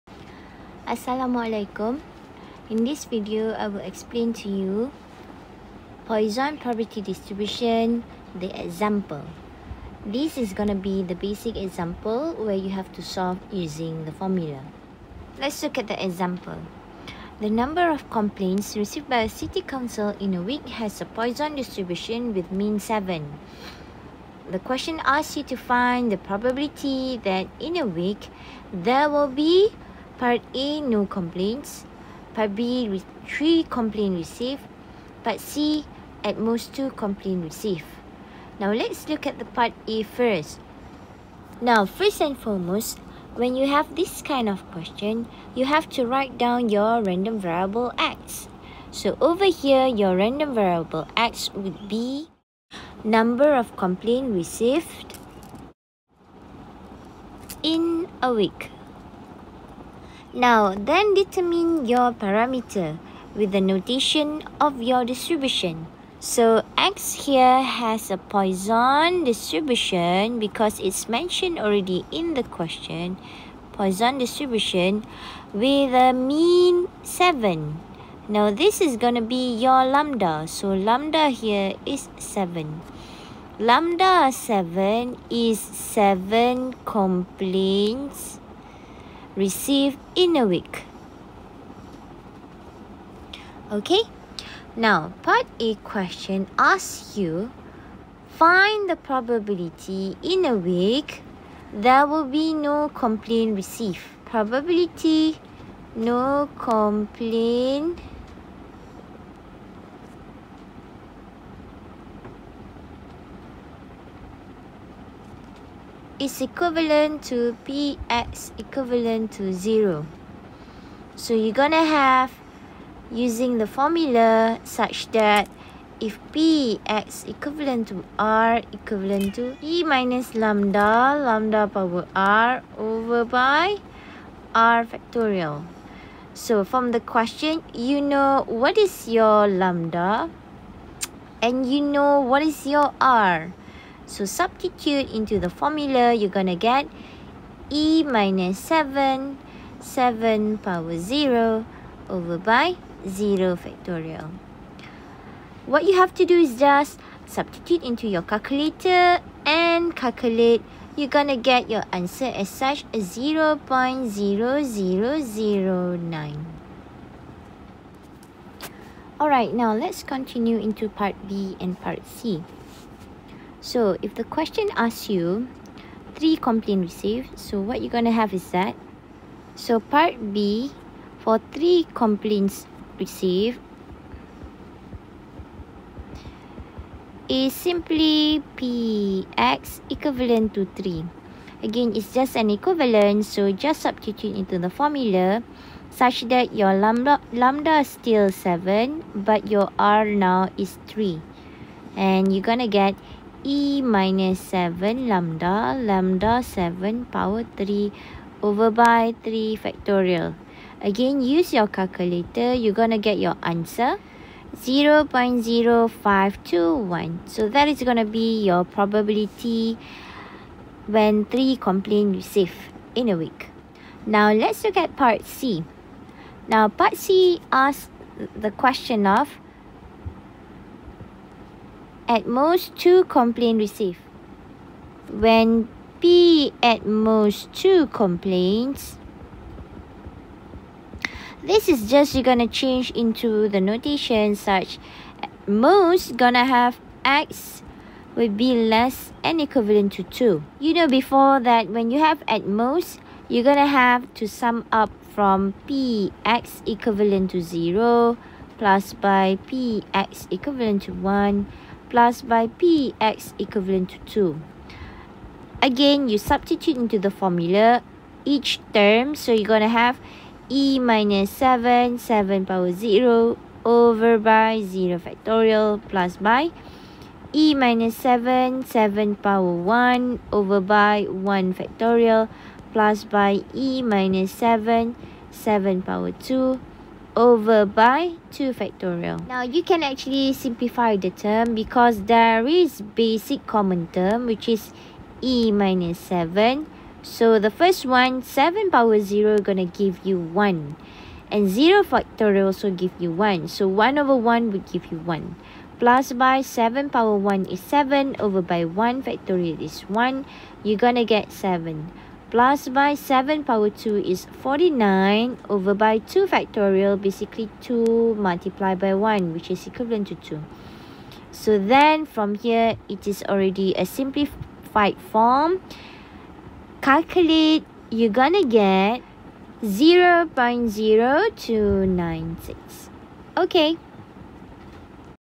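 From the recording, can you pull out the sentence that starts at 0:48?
So over here, your random variable x would be number of complaints received in a week.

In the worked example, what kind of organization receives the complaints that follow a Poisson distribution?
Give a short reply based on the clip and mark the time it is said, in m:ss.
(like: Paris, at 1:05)
city council, at 0:19.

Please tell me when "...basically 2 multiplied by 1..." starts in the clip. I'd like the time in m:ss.
5:16.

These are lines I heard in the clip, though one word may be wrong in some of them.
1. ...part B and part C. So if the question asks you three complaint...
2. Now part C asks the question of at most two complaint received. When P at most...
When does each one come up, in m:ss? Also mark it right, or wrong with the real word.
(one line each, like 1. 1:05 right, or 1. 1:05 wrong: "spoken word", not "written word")
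1. 2:50 right
2. 3:46 right.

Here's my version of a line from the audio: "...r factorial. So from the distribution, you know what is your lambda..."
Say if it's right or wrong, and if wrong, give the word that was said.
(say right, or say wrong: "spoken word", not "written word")
wrong: "question", not "distribution".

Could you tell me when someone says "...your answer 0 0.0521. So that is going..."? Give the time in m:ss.
3:33.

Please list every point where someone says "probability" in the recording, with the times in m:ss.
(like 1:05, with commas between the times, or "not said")
0:06, 0:26, 1:38, 1:44, 3:38.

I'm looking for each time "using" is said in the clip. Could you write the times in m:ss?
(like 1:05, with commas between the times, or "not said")
0:13, 2:03.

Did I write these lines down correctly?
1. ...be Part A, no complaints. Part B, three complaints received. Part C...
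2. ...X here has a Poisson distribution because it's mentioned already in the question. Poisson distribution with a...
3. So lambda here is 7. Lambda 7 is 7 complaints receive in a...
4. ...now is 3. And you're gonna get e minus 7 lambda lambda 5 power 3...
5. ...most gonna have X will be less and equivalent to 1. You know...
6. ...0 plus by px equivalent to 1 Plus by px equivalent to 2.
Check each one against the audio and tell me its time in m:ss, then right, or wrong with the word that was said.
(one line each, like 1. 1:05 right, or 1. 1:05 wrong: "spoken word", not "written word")
1. 0:29 right
2. 1:06 right
3. 1:20 right
4. 3:20 wrong: "7", not "5"
5. 4:05 wrong: "2", not "1"
6. 4:17 right.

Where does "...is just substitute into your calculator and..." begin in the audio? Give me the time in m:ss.
2:36.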